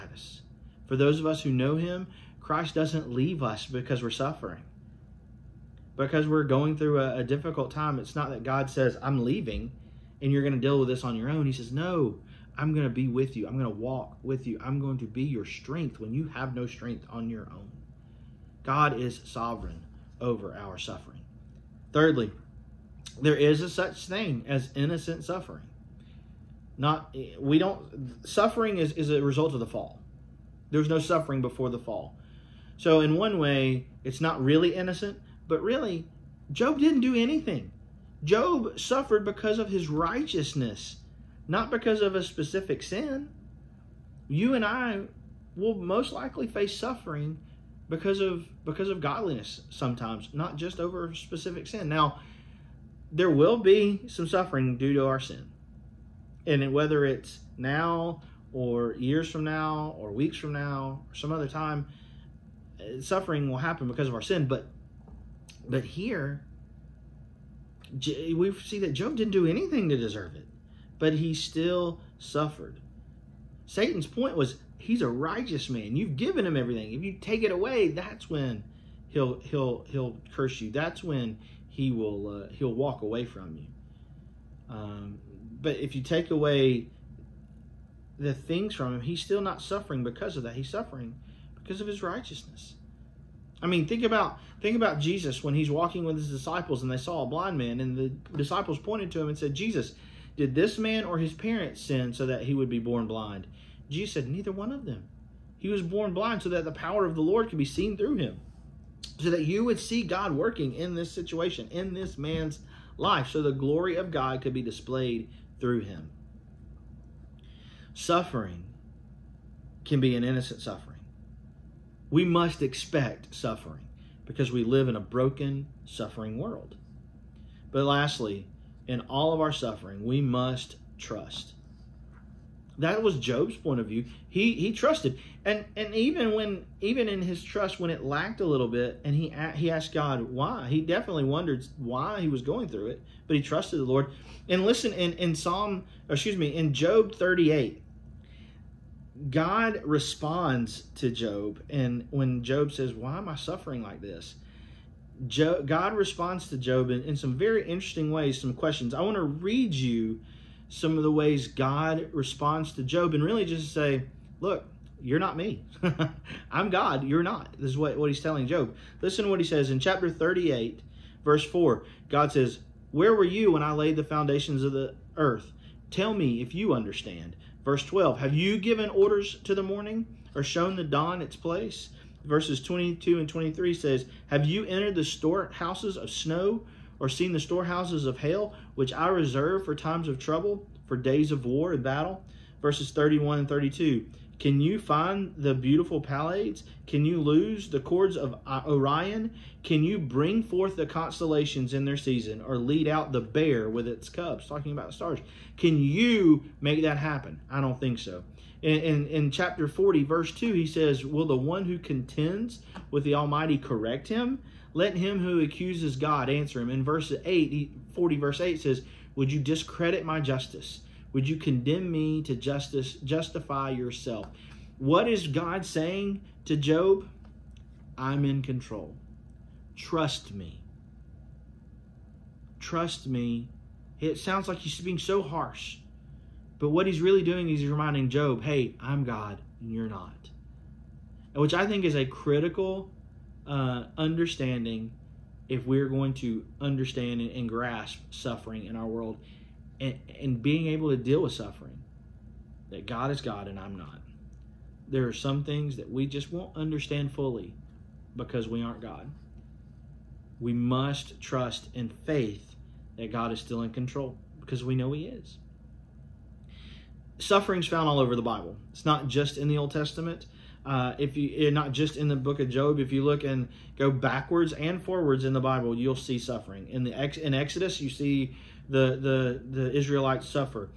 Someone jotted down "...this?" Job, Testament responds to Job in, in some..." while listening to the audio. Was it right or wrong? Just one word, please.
wrong.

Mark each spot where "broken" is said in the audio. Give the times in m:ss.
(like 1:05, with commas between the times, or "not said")
2:05.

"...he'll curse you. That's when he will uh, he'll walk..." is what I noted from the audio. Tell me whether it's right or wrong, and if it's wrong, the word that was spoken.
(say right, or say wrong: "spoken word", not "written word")
right.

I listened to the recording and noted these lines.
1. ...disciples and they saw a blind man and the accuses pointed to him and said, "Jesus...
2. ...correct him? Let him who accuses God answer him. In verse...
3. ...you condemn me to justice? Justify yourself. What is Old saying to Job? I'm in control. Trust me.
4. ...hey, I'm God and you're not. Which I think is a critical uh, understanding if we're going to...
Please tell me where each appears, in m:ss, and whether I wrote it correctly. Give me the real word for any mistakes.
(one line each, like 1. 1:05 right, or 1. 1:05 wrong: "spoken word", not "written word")
1. 1:36 wrong: "disciples", not "accuses"
2. 3:33 right
3. 3:41 wrong: "God", not "Old"
4. 3:58 right.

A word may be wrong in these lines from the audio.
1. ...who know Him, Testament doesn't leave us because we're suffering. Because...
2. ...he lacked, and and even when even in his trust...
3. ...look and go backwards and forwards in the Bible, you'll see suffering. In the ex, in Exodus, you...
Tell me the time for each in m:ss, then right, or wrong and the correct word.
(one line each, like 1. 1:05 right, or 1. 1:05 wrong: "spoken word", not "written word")
1. 0:01 wrong: "Christ", not "Testament"
2. 2:14 wrong: "trusted", not "lacked"
3. 4:33 right.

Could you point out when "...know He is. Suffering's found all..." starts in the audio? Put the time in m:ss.
4:24.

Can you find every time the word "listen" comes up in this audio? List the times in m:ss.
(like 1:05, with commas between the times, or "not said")
2:24, 2:49.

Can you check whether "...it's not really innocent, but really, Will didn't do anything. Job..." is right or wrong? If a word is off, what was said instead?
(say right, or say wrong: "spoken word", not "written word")
wrong: "Job", not "Will".